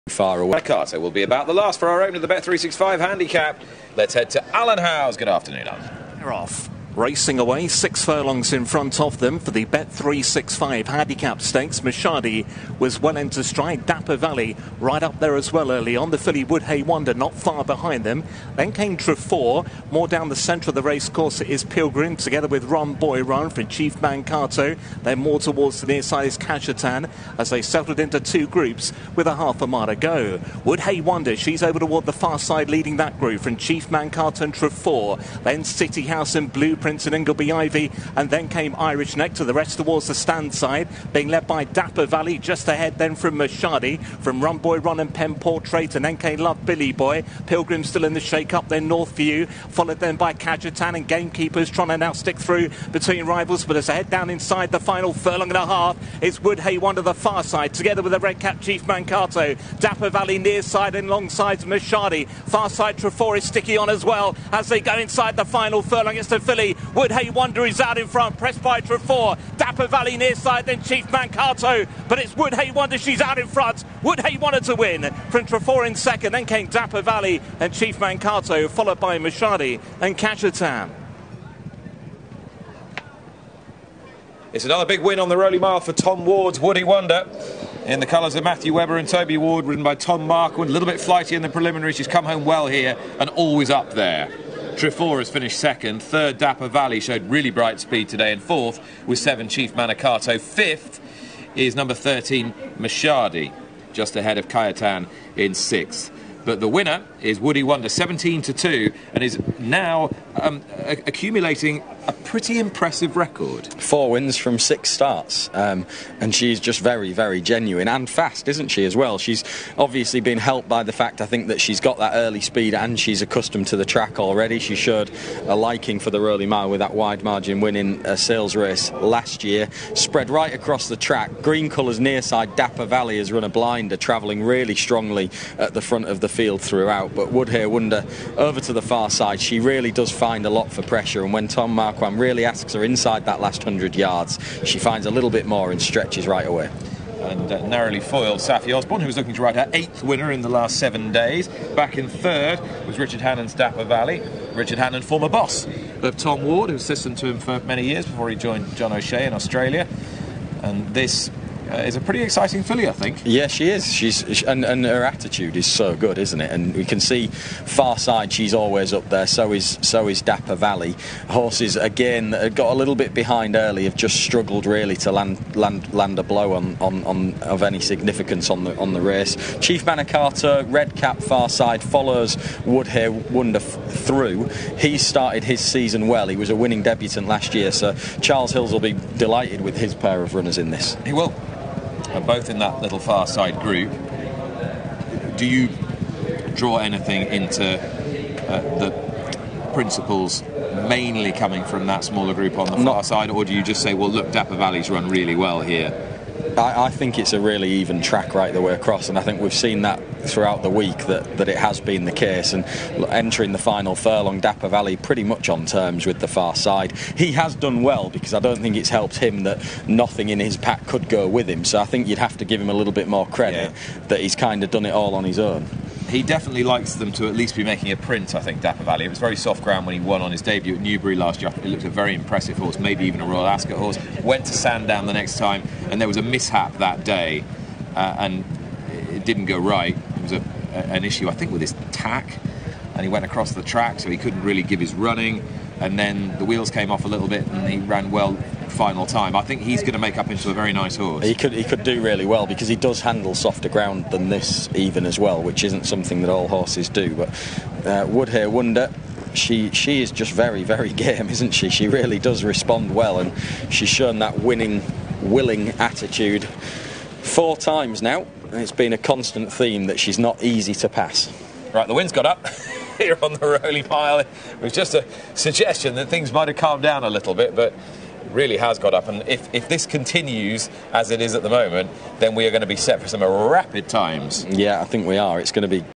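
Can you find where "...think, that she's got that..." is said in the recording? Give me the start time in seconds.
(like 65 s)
121 s.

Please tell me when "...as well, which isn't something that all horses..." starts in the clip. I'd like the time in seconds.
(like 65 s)
255 s.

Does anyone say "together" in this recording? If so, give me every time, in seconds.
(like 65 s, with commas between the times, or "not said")
22 s, 57 s.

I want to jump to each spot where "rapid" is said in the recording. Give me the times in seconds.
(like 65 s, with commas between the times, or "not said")
283 s.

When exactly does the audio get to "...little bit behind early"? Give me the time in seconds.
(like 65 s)
172 s.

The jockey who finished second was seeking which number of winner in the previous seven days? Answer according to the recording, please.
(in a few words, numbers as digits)
eighth.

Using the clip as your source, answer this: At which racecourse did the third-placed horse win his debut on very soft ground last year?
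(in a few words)
Newbury.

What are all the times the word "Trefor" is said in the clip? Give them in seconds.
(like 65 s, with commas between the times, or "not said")
18 s, 34 s, 62 s, 68 s, 75 s, 94 s.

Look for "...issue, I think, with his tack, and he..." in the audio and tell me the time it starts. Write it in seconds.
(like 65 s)
241 s.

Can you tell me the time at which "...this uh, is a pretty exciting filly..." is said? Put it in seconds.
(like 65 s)
160 s.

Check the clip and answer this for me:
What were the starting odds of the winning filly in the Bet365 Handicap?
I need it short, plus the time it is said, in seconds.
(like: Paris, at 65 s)
17 to 2, at 107 s.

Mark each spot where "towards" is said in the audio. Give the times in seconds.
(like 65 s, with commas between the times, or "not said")
25 s, 31 s, 39 s.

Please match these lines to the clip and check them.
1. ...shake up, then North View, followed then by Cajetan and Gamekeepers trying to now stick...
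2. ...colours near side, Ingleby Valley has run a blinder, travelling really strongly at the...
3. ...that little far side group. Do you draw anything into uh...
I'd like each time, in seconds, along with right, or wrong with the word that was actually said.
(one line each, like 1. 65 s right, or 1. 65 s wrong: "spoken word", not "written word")
1. 48 s right
2. 131 s wrong: "Dapper", not "Ingleby"
3. 192 s right.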